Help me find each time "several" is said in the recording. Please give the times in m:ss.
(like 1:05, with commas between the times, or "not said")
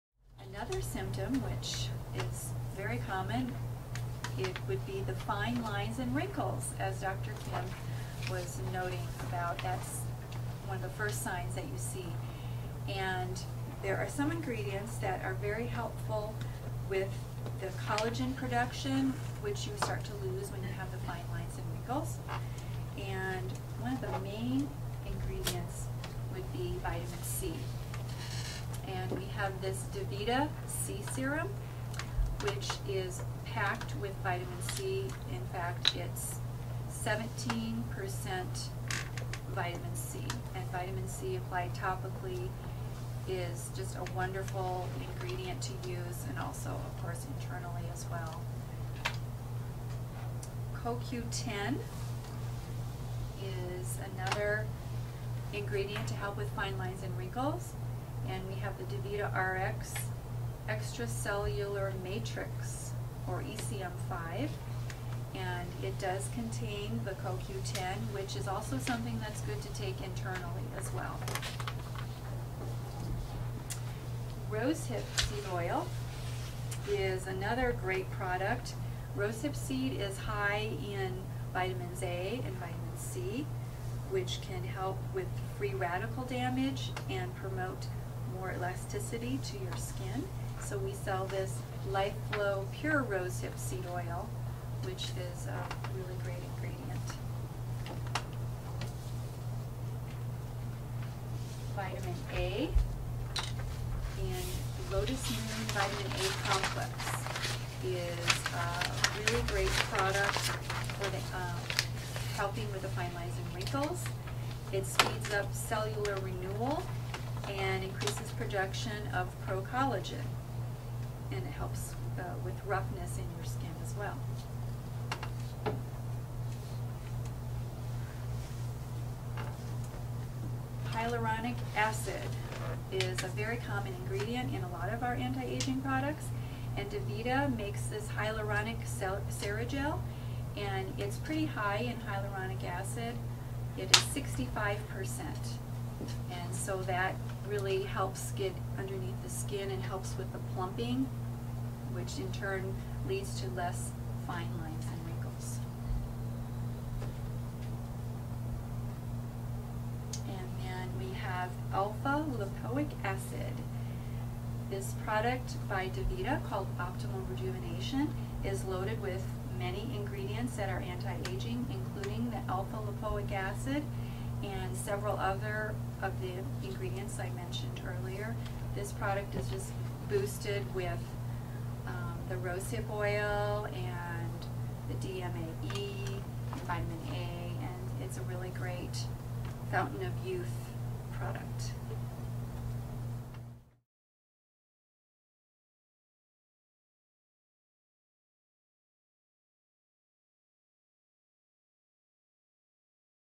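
2:54.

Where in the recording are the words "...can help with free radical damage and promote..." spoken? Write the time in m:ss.
1:24.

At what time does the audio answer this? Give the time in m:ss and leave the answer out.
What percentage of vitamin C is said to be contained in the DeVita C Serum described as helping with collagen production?
0:37.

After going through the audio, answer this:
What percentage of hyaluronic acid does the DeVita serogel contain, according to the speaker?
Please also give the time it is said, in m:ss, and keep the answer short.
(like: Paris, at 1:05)
65%, at 2:24.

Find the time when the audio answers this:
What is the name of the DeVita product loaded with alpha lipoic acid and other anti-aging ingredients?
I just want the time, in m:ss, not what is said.
2:46.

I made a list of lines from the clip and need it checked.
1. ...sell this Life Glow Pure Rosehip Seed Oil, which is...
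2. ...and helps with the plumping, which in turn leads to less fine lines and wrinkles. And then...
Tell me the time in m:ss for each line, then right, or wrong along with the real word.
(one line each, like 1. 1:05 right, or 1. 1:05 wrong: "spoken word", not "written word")
1. 1:30 right
2. 2:29 right.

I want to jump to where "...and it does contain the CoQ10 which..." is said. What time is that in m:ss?
1:05.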